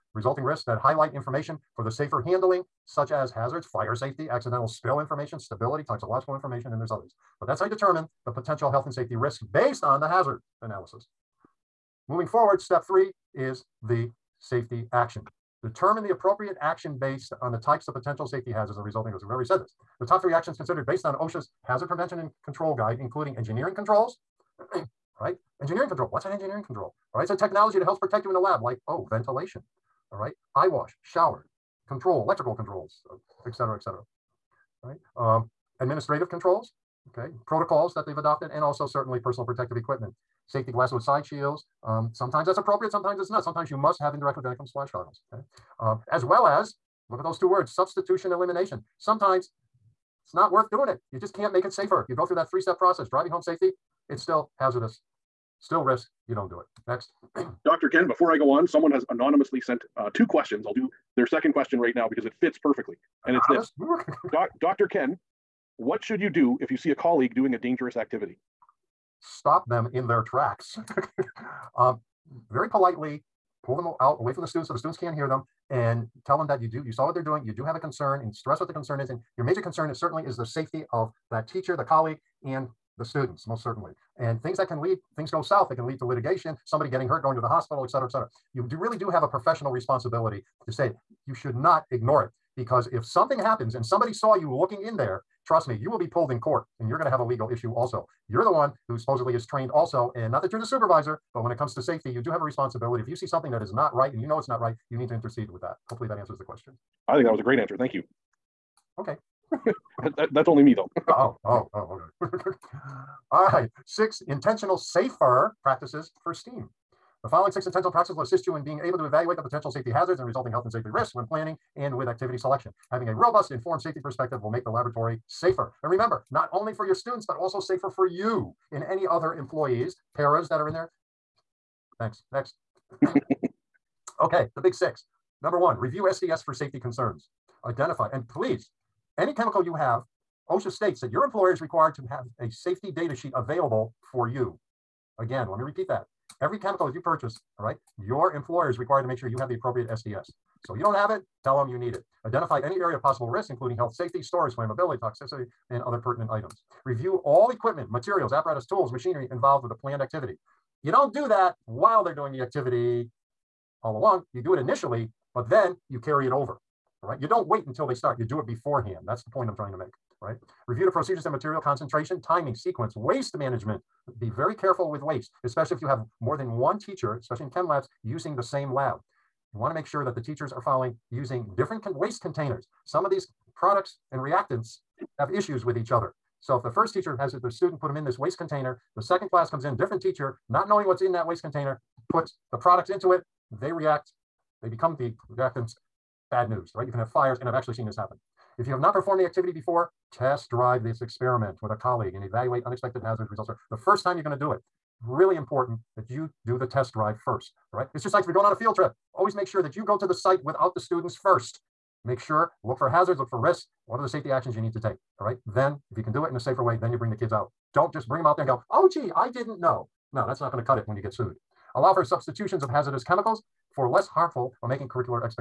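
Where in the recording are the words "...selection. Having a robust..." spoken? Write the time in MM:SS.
02:02.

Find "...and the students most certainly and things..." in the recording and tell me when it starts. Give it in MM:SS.
01:22.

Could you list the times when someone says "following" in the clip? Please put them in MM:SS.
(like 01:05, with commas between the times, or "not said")
01:57, 03:00.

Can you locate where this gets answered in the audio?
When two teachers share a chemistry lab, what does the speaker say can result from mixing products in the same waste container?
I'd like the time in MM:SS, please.
03:17.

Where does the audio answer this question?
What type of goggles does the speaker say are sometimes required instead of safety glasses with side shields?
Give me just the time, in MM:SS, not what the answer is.
00:44.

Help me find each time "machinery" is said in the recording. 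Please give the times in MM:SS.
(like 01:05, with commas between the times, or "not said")
02:38.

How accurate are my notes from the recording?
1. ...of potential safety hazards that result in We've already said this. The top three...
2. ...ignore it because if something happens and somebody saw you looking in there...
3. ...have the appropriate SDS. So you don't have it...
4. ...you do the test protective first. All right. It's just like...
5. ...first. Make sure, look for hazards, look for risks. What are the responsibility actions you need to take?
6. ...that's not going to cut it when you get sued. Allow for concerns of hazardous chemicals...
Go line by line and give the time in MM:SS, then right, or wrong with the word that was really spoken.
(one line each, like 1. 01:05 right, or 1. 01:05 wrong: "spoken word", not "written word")
1. 00:17 right
2. 01:31 right
3. 02:29 right
4. 03:26 wrong: "drive", not "protective"
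5. 03:31 wrong: "safety", not "responsibility"
6. 03:40 wrong: "substitutions", not "concerns".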